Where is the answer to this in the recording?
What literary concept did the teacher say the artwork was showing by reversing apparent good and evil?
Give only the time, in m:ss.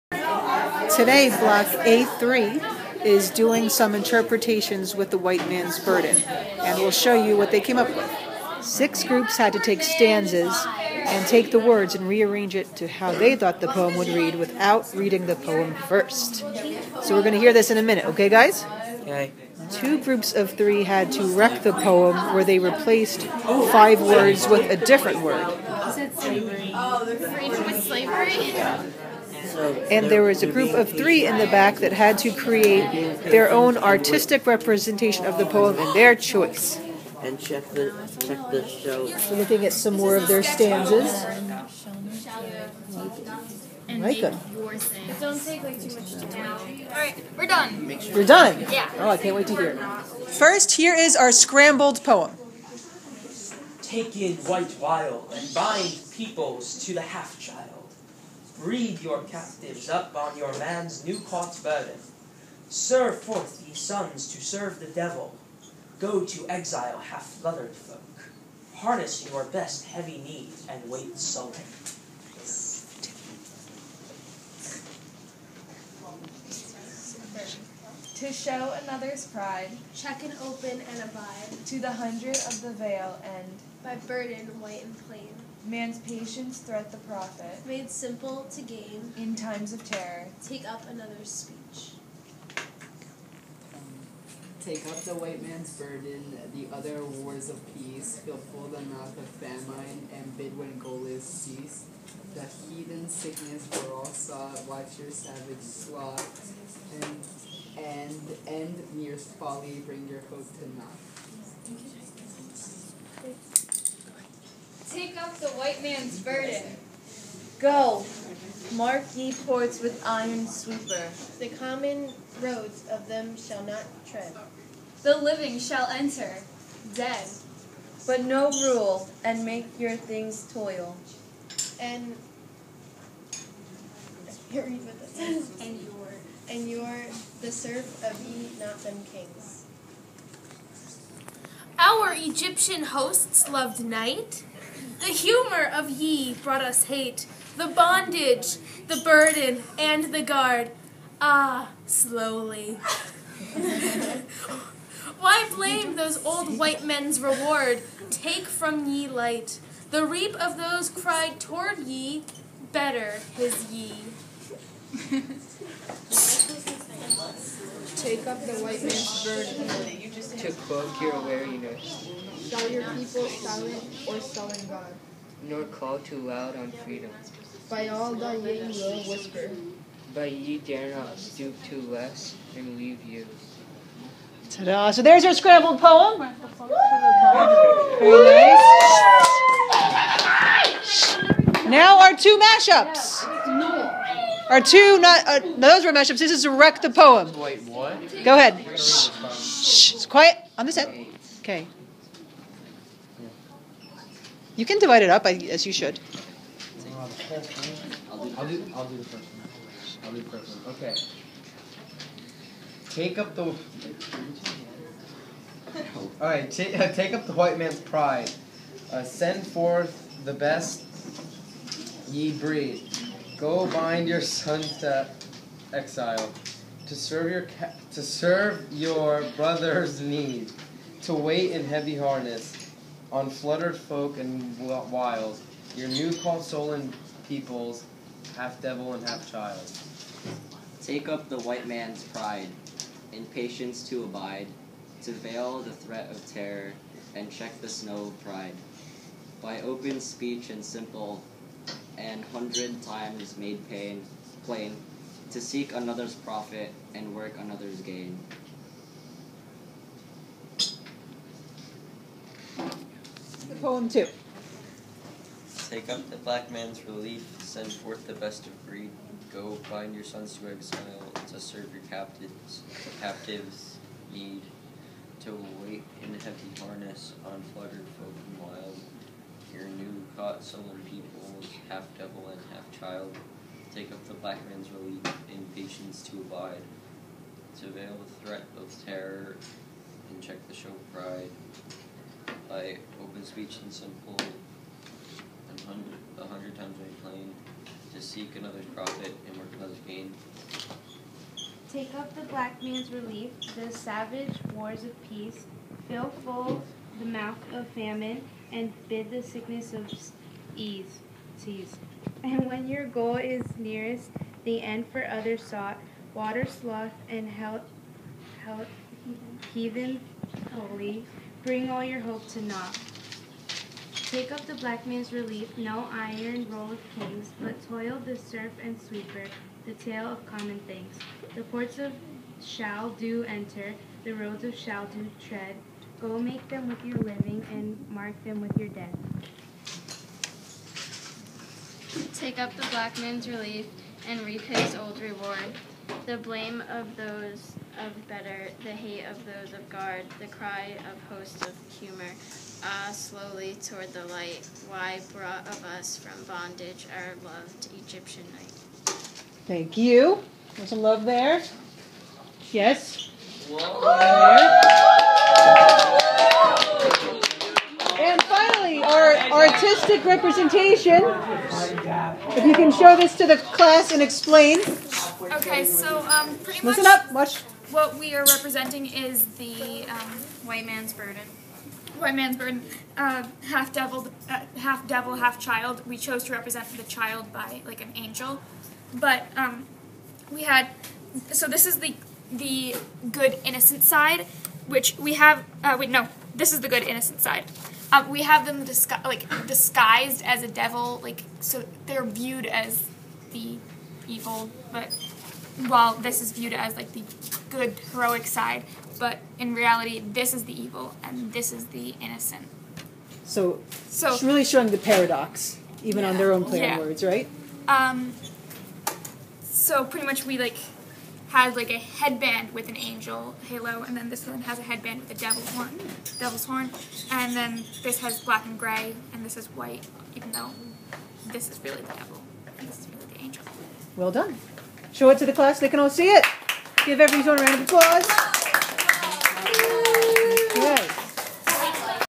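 6:54.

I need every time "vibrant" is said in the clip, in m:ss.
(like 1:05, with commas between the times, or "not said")
not said.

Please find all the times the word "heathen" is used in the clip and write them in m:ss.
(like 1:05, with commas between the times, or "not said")
1:42, 5:19.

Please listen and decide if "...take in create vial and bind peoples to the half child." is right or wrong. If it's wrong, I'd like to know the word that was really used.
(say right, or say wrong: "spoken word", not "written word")
wrong: "white", not "create".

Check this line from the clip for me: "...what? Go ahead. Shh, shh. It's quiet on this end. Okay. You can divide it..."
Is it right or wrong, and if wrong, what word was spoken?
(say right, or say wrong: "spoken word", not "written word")
right.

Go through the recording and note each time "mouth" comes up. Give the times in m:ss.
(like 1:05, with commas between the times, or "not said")
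1:38, 5:07.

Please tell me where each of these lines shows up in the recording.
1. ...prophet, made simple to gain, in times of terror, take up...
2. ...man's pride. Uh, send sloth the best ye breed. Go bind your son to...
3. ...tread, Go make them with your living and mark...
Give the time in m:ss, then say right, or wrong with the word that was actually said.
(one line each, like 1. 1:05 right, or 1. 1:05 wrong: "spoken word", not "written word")
1. 1:26 right
2. 3:37 wrong: "forth", not "sloth"
3. 5:35 right.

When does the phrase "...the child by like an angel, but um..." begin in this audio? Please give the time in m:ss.
6:26.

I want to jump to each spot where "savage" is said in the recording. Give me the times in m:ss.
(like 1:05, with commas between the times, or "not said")
1:45, 5:03.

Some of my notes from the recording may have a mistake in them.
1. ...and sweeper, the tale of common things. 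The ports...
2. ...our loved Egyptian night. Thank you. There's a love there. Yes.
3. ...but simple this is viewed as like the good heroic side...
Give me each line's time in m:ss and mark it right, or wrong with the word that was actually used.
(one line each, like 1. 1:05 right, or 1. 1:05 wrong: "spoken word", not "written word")
1. 5:28 right
2. 5:56 right
3. 6:44 wrong: "while", not "simple".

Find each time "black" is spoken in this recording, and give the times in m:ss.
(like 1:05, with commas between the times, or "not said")
4:26, 4:44, 5:02, 5:24, 5:42, 7:08.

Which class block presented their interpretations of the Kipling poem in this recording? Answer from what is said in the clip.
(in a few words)
A3.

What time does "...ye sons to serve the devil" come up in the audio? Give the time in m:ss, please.
1:03.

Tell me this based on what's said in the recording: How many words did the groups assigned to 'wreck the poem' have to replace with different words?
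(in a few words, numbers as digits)
5.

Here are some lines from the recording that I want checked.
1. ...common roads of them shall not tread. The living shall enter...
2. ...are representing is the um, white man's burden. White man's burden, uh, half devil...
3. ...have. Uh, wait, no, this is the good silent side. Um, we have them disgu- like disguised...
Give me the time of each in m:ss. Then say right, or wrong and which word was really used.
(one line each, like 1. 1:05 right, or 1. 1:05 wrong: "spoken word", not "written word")
1. 2:01 right
2. 6:18 right
3. 6:35 wrong: "innocent", not "silent".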